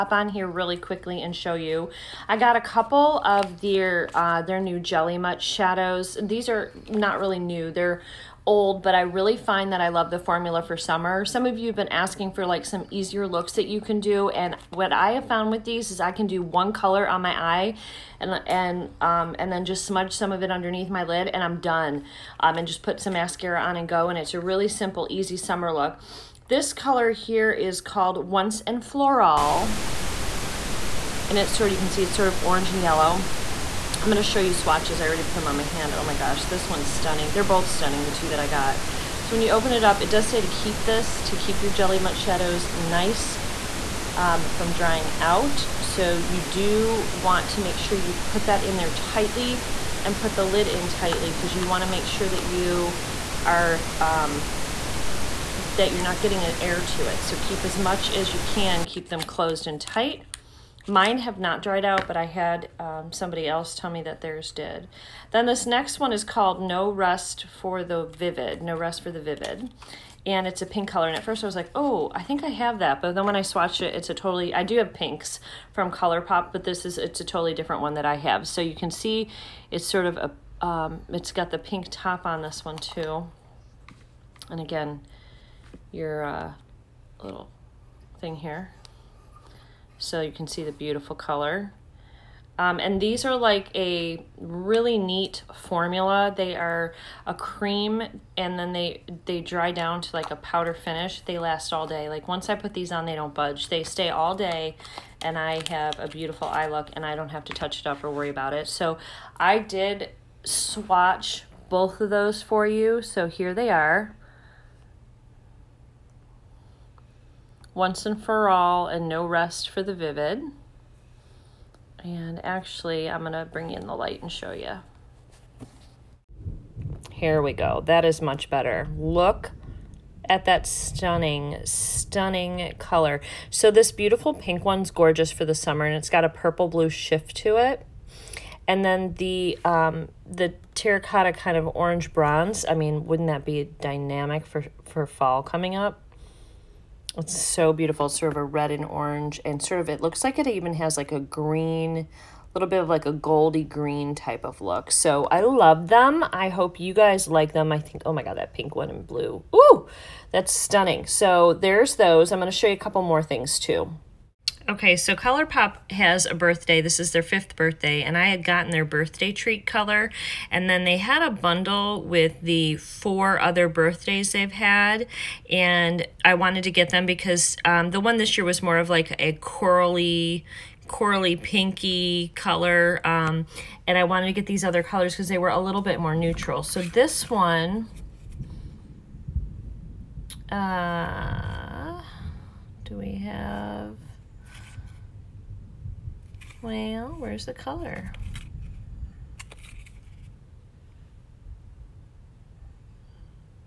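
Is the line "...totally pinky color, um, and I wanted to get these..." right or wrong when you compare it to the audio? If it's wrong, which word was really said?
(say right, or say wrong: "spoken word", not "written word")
wrong: "corally", not "totally".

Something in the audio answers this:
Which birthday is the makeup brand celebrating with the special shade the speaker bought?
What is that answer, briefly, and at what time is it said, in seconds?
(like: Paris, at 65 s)
fifth, at 167 s.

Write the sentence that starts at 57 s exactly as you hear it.
So keep as much as you can, keep them closed and tight.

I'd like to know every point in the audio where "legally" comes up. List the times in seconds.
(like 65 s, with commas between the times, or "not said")
not said.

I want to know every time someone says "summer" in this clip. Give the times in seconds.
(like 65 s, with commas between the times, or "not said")
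10 s, 25 s, 135 s.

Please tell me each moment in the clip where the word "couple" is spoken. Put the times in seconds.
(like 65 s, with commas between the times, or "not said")
2 s, 162 s.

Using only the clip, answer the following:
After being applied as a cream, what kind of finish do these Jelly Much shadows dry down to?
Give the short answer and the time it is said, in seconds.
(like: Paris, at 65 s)
powder finish, at 100 s.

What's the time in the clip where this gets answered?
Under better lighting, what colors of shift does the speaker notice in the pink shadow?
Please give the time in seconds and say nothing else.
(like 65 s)
136 s.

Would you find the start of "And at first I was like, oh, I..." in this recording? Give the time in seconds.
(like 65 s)
71 s.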